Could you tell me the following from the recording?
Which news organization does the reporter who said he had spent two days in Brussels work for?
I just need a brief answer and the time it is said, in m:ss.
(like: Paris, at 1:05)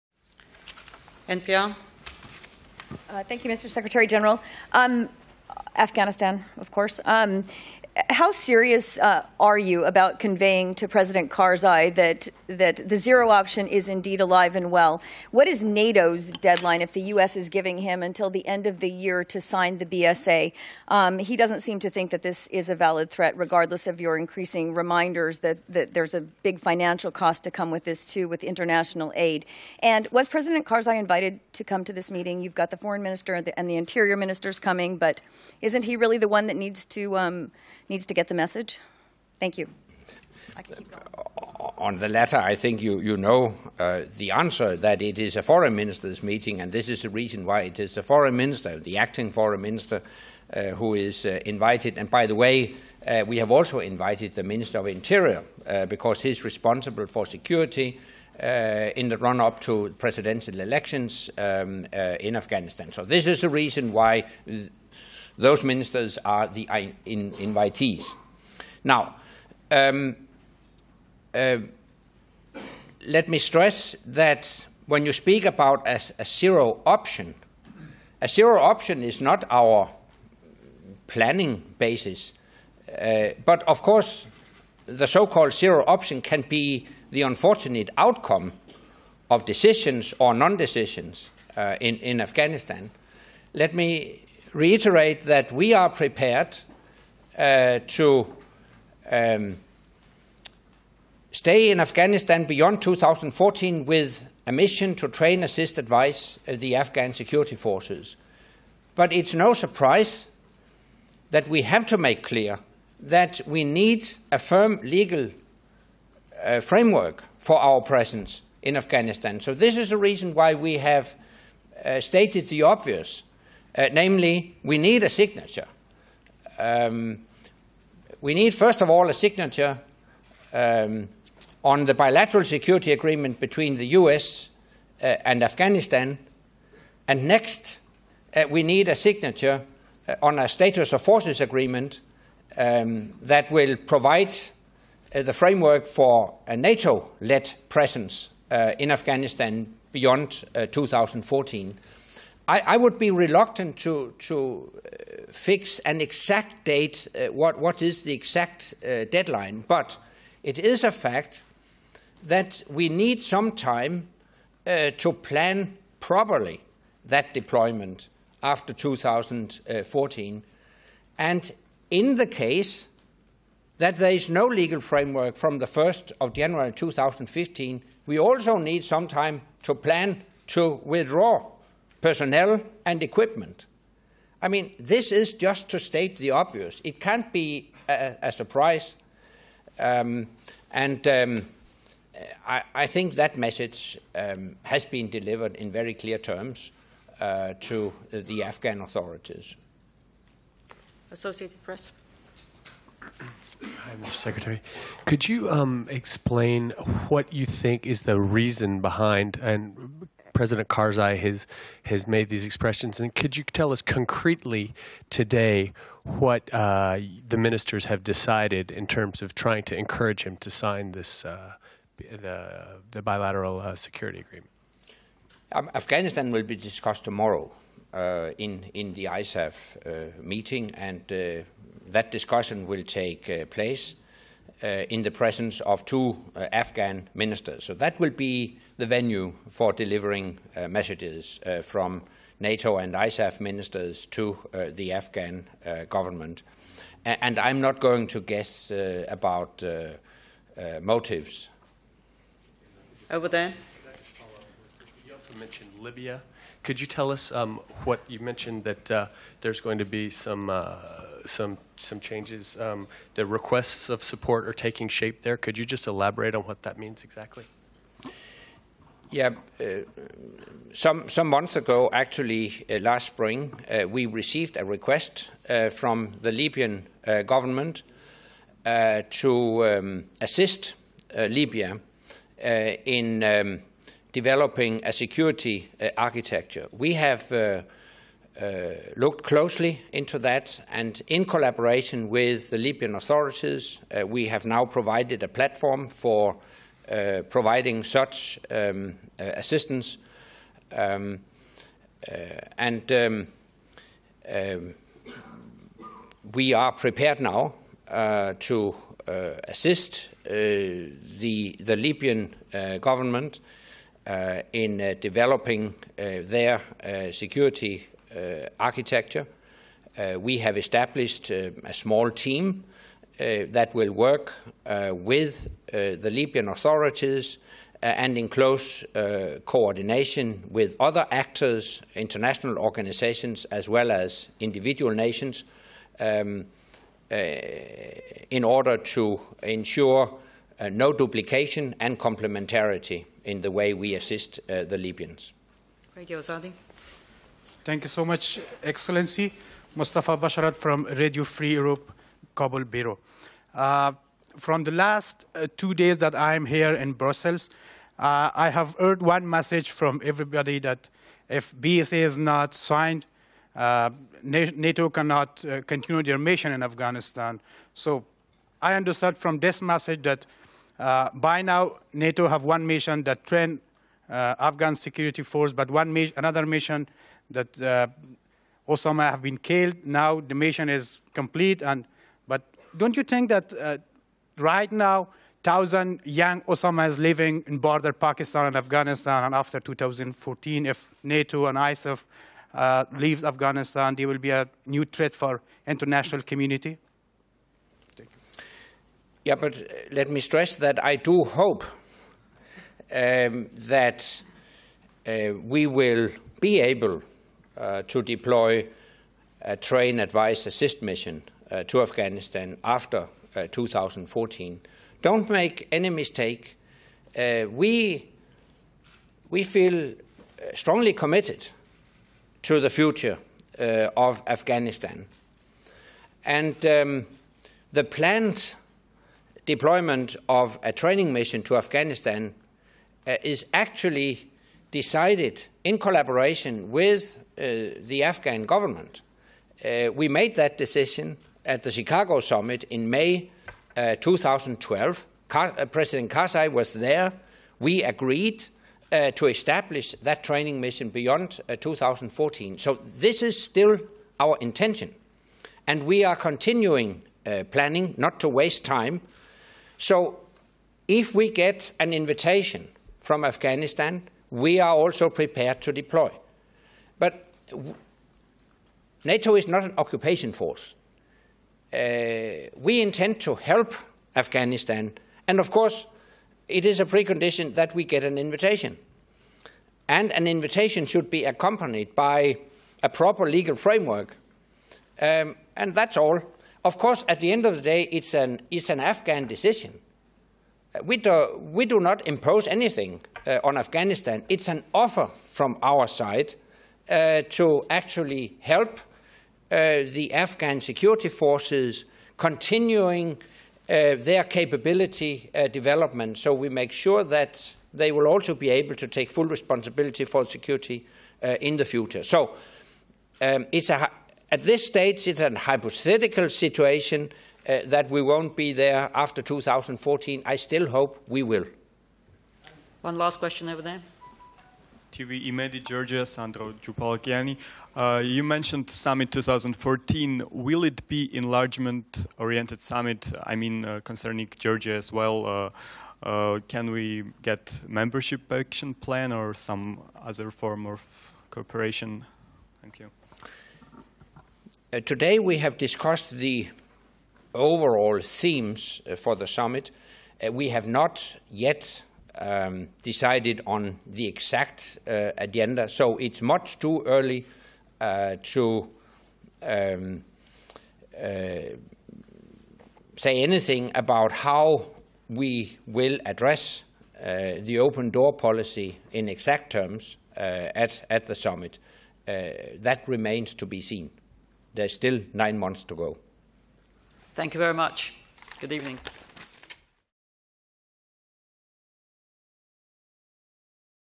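Radio Free Europe, at 5:50.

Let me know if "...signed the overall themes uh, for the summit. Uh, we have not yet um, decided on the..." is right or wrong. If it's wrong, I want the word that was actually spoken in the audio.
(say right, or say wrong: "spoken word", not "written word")
wrong: "discussed", not "signed".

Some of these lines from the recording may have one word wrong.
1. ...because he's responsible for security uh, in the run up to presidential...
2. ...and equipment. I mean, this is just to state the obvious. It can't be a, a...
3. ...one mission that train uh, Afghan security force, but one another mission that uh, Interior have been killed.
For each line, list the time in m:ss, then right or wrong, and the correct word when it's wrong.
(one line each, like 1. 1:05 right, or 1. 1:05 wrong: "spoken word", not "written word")
1. 0:55 right
2. 3:02 right
3. 6:12 wrong: "Osama", not "Interior".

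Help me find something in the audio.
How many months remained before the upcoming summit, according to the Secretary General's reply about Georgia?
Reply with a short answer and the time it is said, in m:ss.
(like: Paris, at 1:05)
9, at 9:35.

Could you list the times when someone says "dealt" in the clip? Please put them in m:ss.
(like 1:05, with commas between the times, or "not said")
not said.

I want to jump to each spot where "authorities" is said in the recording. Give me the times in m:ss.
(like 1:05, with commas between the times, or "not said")
3:18, 4:52, 5:26.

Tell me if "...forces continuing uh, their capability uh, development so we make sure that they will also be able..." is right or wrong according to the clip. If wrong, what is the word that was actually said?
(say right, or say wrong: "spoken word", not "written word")
right.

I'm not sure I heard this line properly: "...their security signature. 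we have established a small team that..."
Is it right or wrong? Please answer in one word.
wrong.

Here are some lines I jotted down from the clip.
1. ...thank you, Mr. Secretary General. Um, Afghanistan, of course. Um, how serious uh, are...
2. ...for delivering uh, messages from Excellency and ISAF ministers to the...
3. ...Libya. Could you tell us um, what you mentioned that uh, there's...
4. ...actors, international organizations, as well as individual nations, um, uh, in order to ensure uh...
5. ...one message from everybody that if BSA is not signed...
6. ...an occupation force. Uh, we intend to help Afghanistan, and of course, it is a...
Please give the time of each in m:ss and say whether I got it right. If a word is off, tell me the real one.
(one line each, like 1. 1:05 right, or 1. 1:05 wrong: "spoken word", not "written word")
1. 0:03 right
2. 3:59 wrong: "NATO", not "Excellency"
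3. 4:15 right
4. 5:31 right
5. 5:59 right
6. 7:49 right.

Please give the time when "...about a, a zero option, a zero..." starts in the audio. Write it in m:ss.
1:15.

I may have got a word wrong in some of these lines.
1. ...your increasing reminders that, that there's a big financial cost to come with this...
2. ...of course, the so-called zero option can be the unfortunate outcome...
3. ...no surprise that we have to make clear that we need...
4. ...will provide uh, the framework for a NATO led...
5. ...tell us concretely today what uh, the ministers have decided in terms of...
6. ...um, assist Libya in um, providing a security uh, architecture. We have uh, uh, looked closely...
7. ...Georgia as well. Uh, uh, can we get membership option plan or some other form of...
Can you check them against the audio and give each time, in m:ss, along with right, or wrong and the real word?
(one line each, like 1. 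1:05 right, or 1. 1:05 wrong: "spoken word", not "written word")
1. 0:24 right
2. 1:23 right
3. 1:49 right
4. 2:23 right
5. 3:33 right
6. 4:39 wrong: "developing", not "providing"
7. 8:54 wrong: "action", not "option".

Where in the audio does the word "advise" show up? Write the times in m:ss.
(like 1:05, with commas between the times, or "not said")
1:45, 6:49.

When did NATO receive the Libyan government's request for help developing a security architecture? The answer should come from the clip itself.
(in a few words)
last spring.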